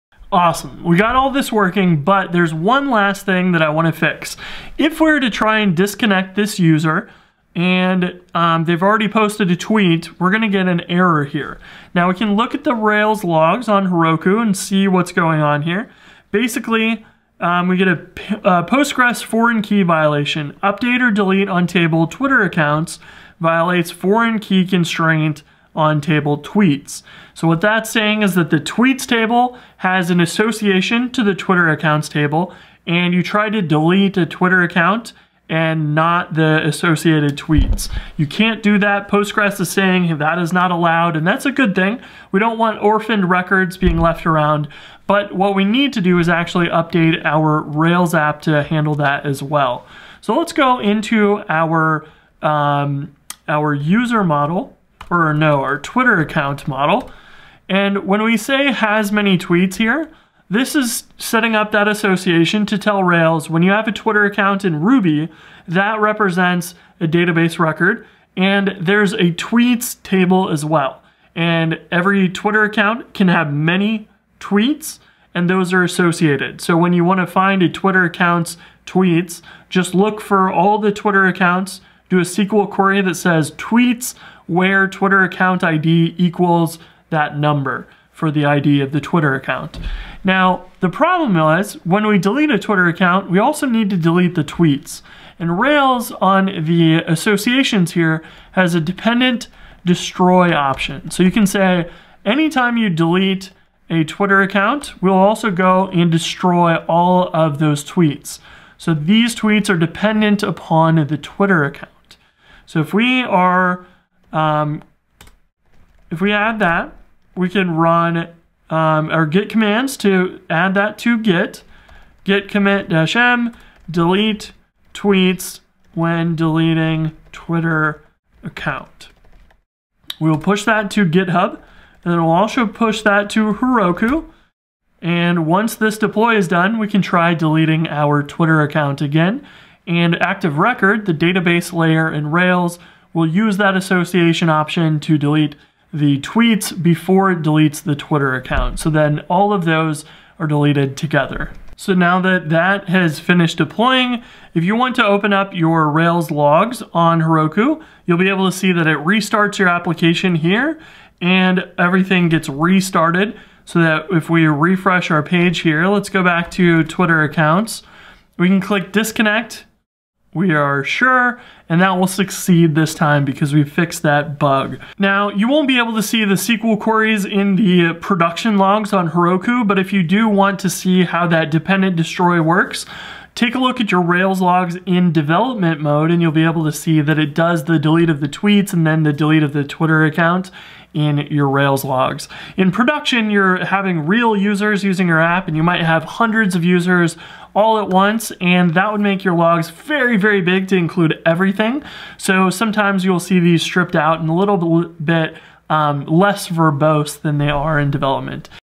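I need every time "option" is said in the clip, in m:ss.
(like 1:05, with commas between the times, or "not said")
1:40, 2:24.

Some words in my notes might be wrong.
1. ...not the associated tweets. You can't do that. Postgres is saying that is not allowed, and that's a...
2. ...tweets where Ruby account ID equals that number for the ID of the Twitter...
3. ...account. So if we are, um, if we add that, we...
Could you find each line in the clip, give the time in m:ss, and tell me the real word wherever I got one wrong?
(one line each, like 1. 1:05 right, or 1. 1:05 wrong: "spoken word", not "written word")
1. 0:35 right
2. 1:23 wrong: "Twitter", not "Ruby"
3. 1:51 right.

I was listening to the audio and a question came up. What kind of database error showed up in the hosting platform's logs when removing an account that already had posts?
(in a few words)
Postgres foreign key violation.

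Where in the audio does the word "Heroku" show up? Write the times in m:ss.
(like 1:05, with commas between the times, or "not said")
0:13, 2:13, 2:37, 2:59.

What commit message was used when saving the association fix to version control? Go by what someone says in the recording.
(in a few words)
delete tweets when deleting Twitter account.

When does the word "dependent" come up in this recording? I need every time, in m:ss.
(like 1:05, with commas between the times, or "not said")
1:38, 1:49, 3:01.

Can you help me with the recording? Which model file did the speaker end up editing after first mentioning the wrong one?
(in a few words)
Twitter account model.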